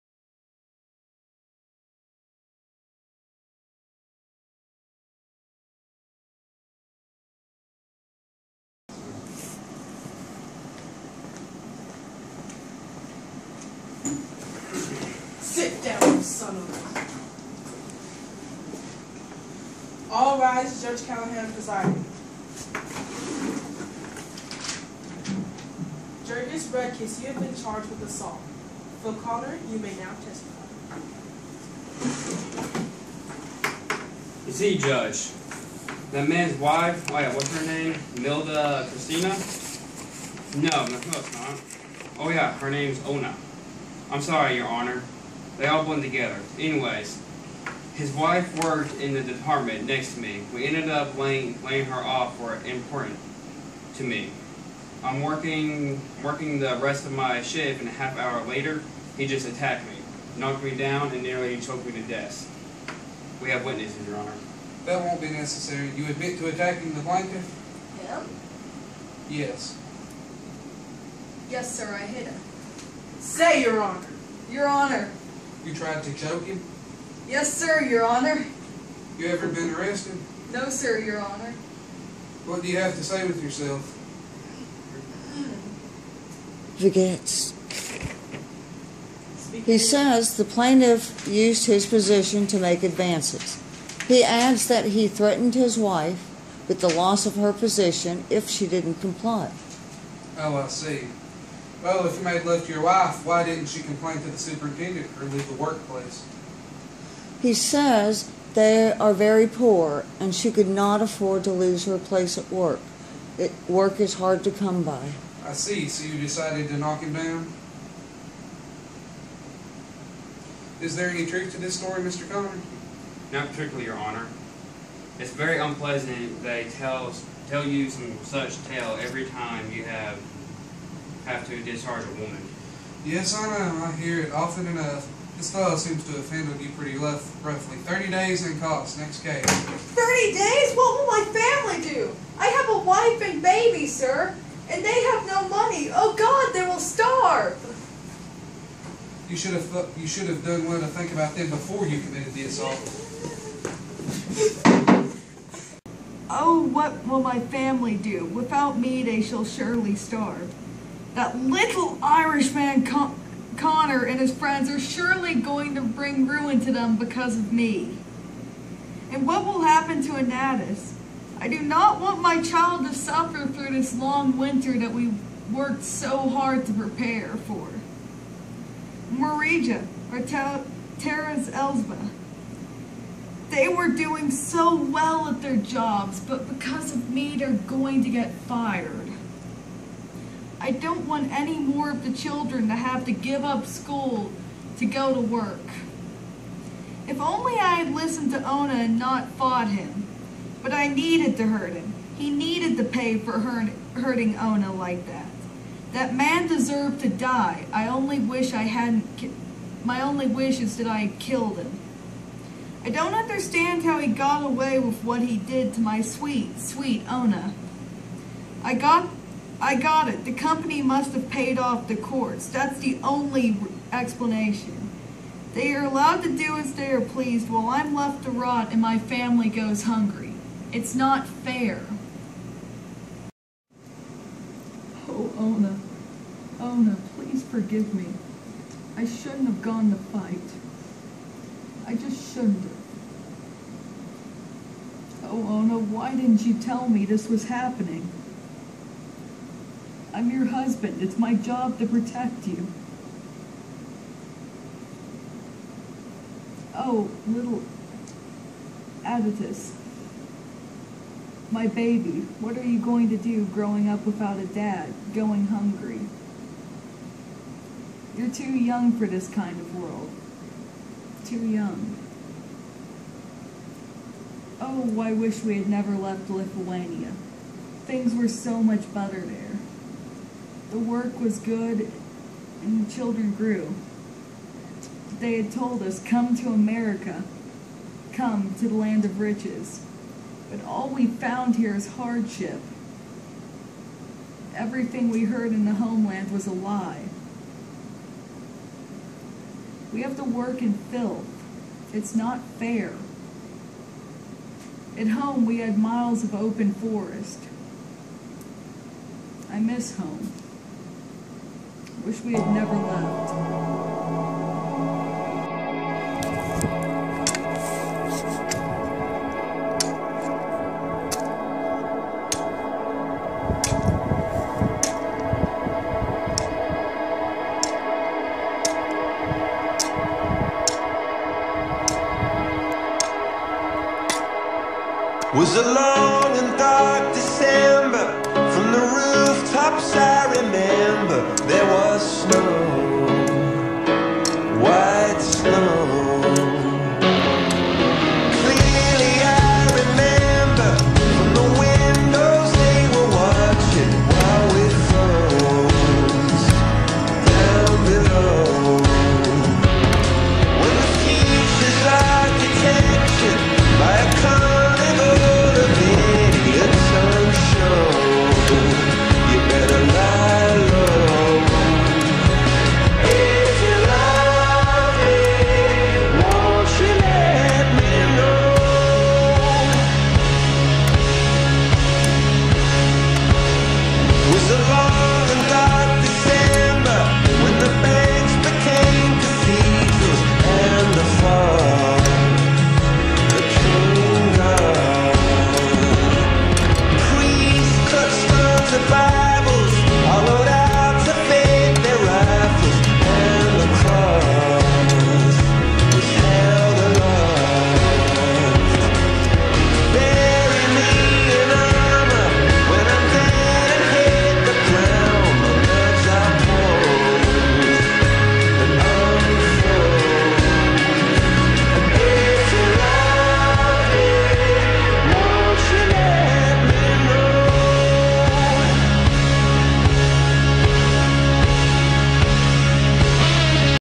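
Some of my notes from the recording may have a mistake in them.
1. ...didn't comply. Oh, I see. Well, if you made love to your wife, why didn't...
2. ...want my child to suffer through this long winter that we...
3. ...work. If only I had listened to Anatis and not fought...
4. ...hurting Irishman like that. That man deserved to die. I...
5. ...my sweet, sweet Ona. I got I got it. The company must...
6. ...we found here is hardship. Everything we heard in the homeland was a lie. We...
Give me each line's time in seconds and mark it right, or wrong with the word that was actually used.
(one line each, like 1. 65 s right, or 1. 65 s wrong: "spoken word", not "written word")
1. 98 s right
2. 171 s right
3. 195 s wrong: "Ona", not "Anatis"
4. 203 s wrong: "Ona", not "Irishman"
5. 215 s right
6. 290 s right.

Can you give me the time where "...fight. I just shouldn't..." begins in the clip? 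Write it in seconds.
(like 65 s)
239 s.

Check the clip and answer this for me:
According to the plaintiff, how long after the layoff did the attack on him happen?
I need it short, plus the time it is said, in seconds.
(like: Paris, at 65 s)
A half hour, at 57 s.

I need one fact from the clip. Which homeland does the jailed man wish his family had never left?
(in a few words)
Lithuania.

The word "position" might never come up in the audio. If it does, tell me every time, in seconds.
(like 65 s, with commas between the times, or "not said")
91 s, 97 s.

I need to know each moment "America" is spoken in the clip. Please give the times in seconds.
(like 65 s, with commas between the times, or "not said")
286 s.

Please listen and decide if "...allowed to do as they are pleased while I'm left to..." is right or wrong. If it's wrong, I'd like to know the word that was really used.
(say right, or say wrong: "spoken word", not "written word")
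right.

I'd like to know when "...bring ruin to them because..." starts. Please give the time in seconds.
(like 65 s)
165 s.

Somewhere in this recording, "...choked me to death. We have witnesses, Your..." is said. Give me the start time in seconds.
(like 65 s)
61 s.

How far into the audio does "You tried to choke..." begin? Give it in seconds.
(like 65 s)
75 s.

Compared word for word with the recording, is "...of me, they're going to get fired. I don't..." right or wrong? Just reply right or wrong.
right.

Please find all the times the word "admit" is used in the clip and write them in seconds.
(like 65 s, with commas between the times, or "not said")
66 s.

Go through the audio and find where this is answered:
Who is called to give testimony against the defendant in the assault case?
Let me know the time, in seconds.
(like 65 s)
29 s.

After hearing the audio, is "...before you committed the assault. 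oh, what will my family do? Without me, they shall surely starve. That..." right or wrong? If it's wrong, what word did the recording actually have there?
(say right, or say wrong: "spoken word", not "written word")
right.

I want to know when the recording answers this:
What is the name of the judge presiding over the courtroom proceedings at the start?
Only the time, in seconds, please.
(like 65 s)
20 s.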